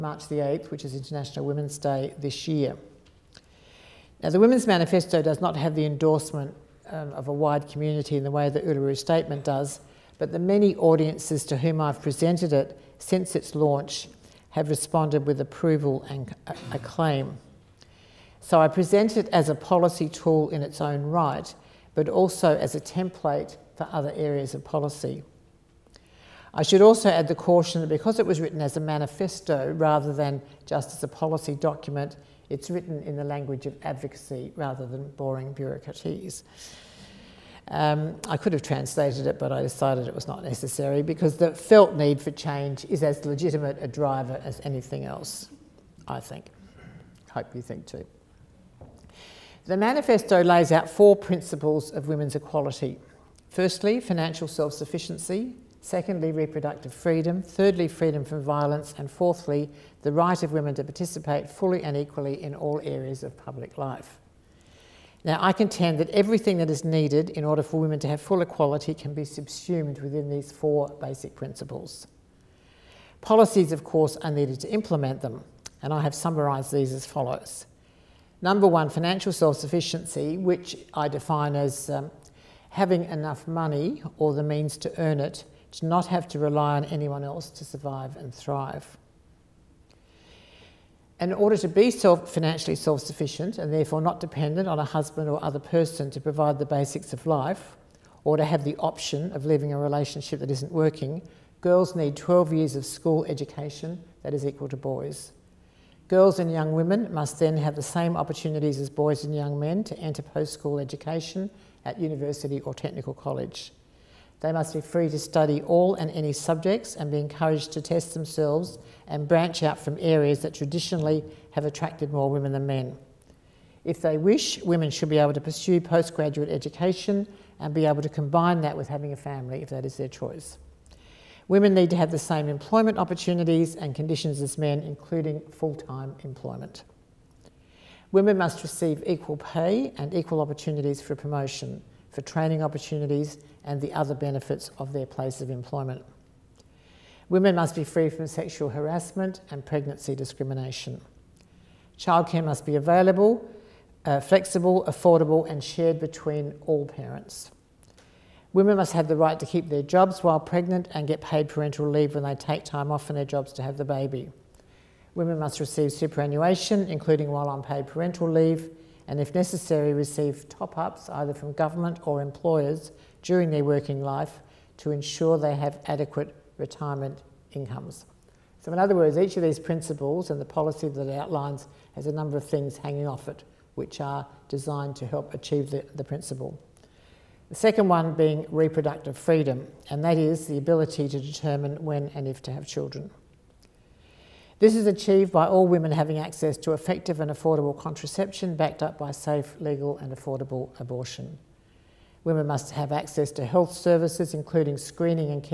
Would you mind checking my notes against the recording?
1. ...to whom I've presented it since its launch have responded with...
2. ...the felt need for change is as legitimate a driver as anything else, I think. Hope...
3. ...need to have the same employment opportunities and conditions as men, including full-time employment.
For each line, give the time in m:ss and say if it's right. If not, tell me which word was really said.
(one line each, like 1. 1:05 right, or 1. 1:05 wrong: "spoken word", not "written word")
1. 0:11 right
2. 0:41 right
3. 2:11 right.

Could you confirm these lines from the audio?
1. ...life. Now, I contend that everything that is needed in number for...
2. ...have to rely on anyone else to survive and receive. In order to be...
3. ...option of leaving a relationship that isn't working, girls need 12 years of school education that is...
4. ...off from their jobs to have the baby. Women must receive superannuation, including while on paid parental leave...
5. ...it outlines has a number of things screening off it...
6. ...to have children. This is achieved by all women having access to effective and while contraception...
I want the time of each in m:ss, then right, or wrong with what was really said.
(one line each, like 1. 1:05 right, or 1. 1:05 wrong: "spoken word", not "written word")
1. 1:03 wrong: "order", not "number"
2. 1:26 wrong: "thrive", not "receive"
3. 1:38 right
4. 2:42 right
5. 3:01 wrong: "hanging", not "screening"
6. 3:12 wrong: "affordable", not "while".